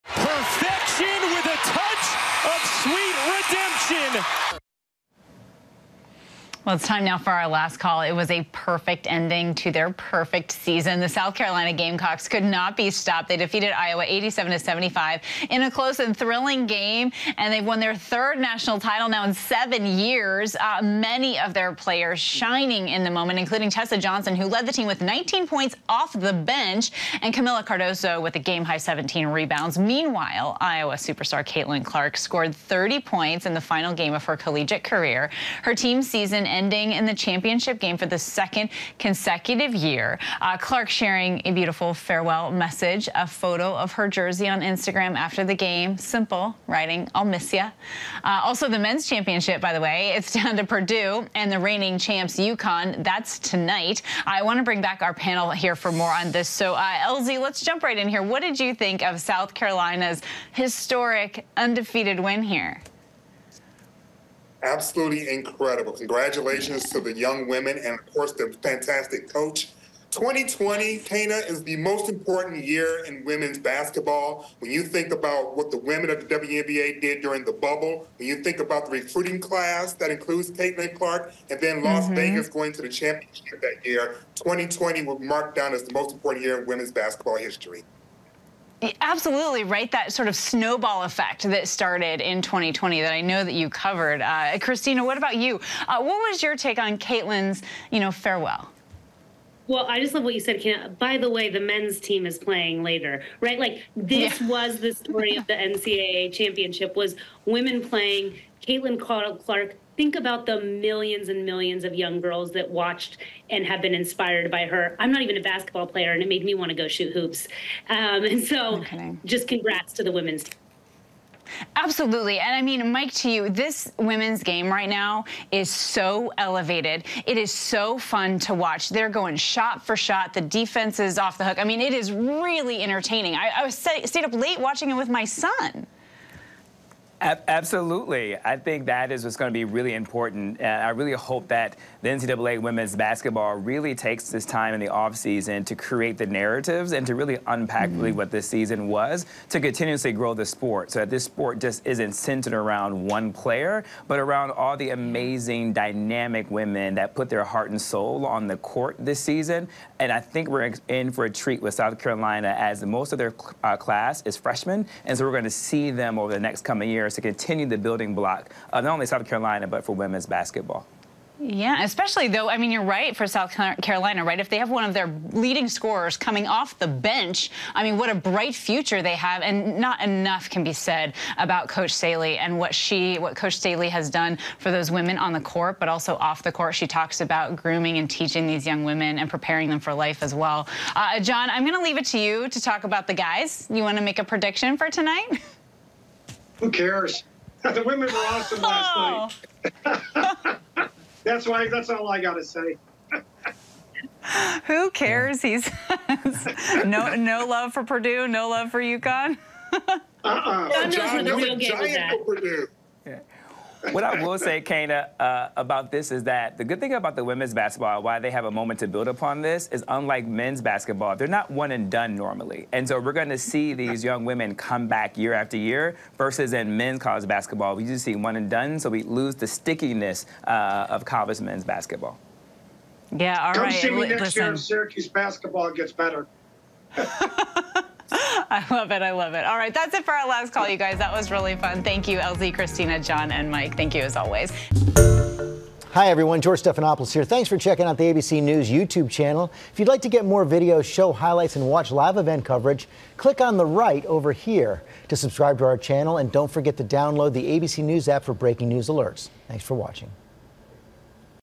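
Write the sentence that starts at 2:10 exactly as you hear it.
The defense is off the hook.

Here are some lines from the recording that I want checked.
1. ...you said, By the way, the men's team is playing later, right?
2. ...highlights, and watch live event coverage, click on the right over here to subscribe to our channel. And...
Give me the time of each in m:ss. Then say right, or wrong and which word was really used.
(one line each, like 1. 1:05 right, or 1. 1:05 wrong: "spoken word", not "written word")
1. 1:40 right
2. 4:11 right.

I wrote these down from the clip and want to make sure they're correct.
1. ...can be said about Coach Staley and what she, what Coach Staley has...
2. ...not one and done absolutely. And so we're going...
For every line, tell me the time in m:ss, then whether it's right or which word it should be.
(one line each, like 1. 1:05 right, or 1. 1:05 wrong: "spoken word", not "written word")
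1. 3:00 right
2. 3:41 wrong: "normally", not "absolutely".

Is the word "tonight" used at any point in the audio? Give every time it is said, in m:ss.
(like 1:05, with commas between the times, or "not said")
0:53, 3:14.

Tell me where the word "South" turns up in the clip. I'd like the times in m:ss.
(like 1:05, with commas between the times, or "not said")
0:11, 0:59, 2:41, 2:49, 2:53.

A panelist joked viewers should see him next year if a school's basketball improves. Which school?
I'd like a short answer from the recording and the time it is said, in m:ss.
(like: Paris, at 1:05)
Syracuse, at 3:54.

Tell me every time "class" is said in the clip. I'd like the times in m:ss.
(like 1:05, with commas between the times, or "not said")
1:19, 2:43.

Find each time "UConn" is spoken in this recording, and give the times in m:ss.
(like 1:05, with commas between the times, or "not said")
0:52, 3:28.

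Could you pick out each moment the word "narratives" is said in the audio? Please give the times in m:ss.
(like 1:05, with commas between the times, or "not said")
2:26.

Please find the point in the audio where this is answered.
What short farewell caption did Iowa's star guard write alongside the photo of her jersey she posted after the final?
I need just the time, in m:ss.
0:47.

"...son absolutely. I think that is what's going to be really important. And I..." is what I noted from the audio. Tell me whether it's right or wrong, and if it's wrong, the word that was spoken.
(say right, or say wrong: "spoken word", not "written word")
right.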